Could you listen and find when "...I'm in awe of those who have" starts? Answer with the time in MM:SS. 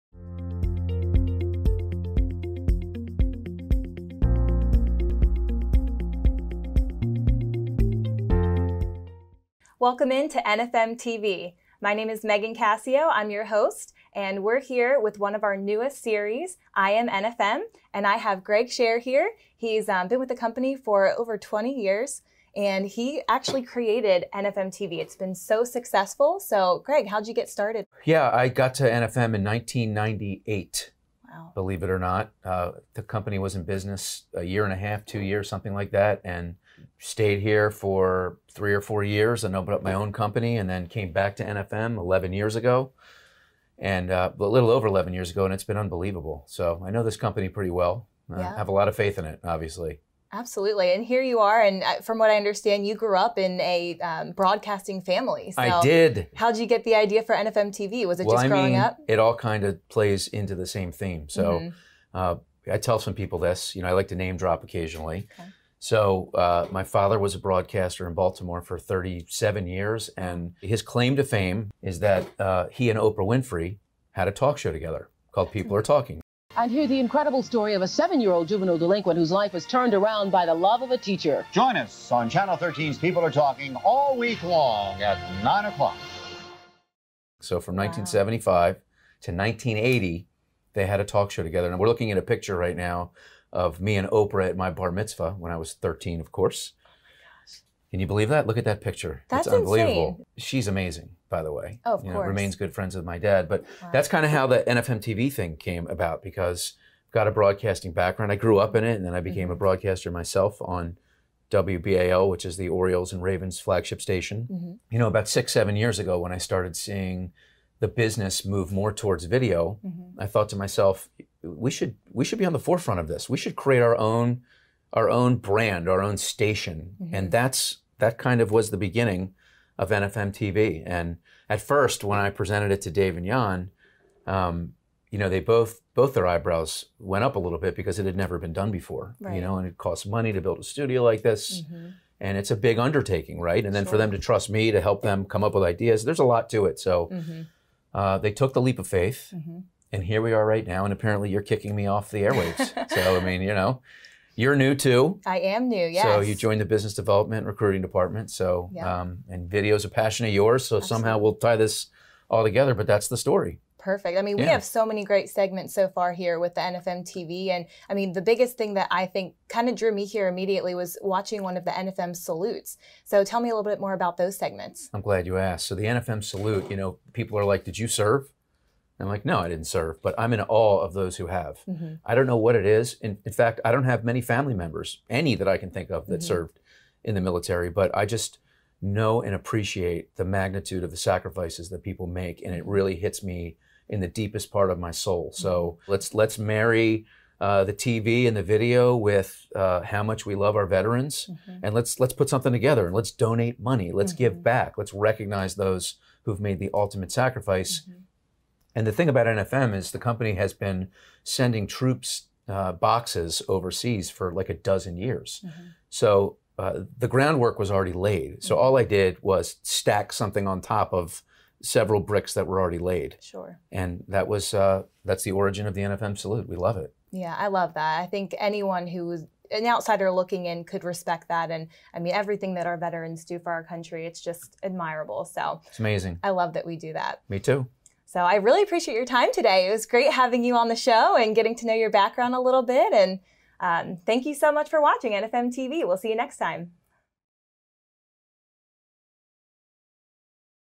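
03:00.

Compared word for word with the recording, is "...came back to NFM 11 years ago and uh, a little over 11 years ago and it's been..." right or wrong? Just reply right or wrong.
right.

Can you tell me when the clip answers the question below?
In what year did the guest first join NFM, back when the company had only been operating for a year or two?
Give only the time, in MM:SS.
00:29.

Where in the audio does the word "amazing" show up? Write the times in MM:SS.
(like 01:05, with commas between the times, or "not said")
01:40, 03:55.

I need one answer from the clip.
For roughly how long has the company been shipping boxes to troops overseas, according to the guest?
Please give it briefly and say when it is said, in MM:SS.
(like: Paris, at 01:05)
a dozen years, at 03:34.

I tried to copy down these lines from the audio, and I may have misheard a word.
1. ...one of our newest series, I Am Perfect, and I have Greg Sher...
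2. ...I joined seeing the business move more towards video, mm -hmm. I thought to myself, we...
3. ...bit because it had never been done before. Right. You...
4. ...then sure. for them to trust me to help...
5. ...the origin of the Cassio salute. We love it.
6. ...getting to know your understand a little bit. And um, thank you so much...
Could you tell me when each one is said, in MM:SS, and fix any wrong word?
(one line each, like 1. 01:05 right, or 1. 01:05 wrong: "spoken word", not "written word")
1. 00:15 wrong: "NFM", not "Perfect"
2. 01:56 wrong: "started", not "joined"
3. 02:17 right
4. 02:23 right
5. 03:45 wrong: "NFM", not "Cassio"
6. 04:01 wrong: "background", not "understand".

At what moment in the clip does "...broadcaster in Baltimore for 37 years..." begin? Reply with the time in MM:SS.
01:07.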